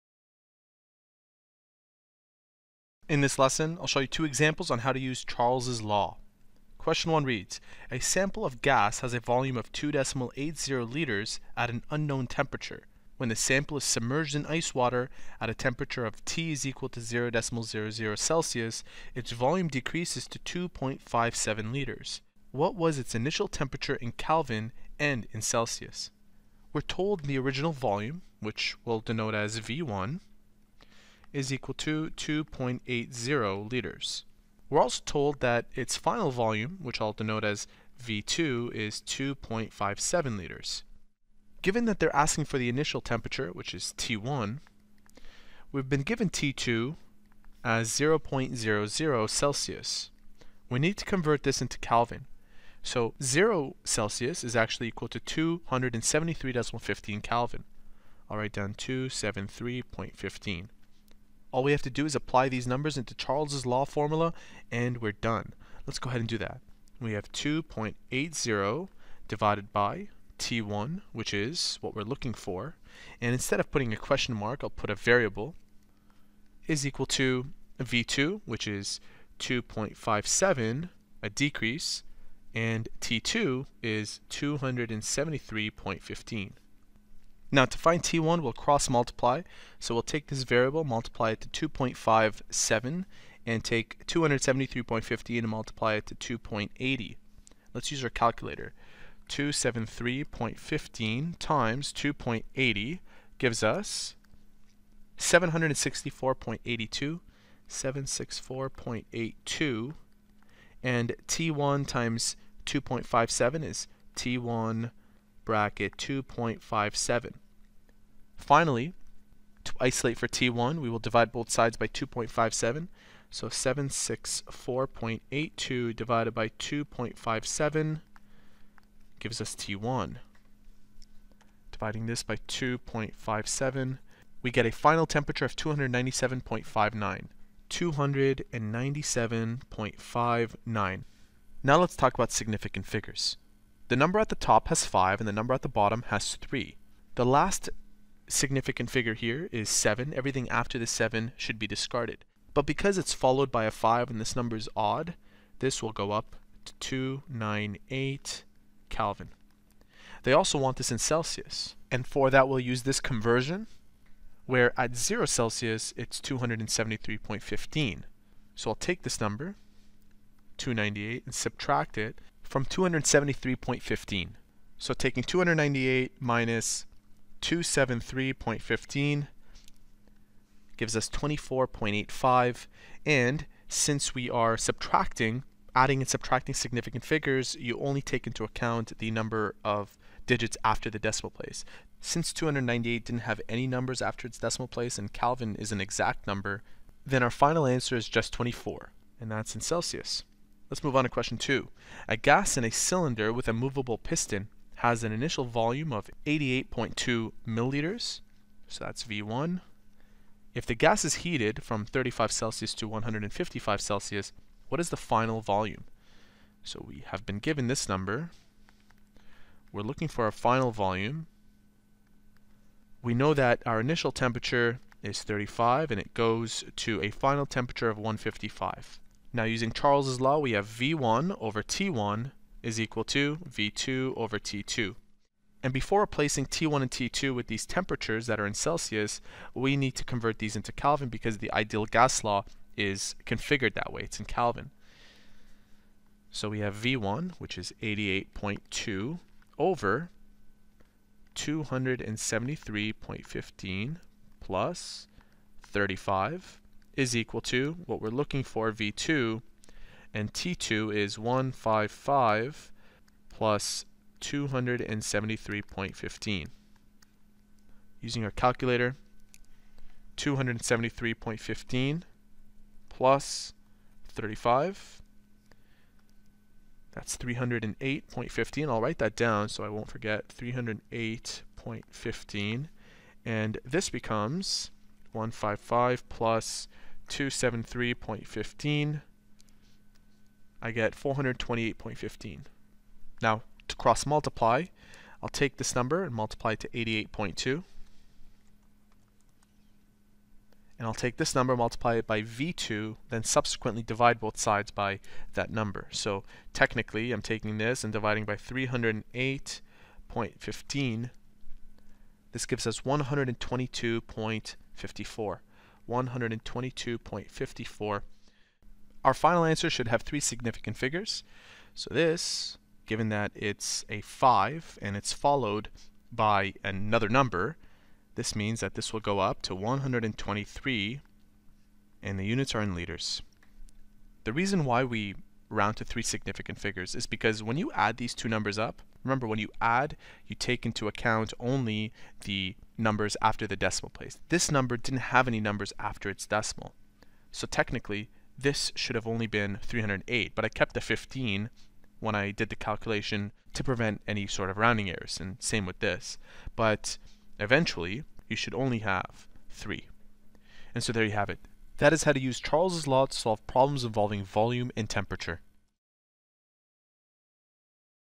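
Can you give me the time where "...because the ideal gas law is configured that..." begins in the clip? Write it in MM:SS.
04:01.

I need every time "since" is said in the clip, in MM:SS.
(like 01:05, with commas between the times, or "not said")
03:03, 03:11.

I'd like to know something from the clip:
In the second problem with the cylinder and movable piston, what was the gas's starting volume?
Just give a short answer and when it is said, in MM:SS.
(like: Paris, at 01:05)
88.2 milliliters, at 03:26.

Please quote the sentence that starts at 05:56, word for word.
But eventually, you should only have 3.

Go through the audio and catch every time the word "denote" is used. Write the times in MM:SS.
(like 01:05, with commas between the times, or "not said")
00:29, 00:37.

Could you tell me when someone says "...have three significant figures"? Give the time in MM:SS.
05:19.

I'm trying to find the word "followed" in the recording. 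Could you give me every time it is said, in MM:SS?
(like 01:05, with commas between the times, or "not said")
02:33, 05:25.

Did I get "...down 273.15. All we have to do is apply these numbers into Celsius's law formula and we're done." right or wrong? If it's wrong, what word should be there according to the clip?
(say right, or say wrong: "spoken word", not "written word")
wrong: "Charles", not "Celsius".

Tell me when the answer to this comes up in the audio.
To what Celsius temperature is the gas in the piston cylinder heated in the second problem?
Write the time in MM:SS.
03:32.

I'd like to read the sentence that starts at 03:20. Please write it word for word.
Let's move on to question two.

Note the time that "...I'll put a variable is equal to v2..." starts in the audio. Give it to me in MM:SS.
01:14.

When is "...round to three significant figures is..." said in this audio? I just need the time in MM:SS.
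05:35.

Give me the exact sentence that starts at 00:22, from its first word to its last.
What was its initial temperature in Kelvin and in Celsius?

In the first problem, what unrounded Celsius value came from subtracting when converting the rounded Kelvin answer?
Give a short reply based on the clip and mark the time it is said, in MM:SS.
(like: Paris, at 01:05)
24.85, at 03:01.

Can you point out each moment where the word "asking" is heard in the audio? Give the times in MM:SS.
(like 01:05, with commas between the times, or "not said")
00:42.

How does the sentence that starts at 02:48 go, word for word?
So I'll take this number, 298, and subtract it from 273.15.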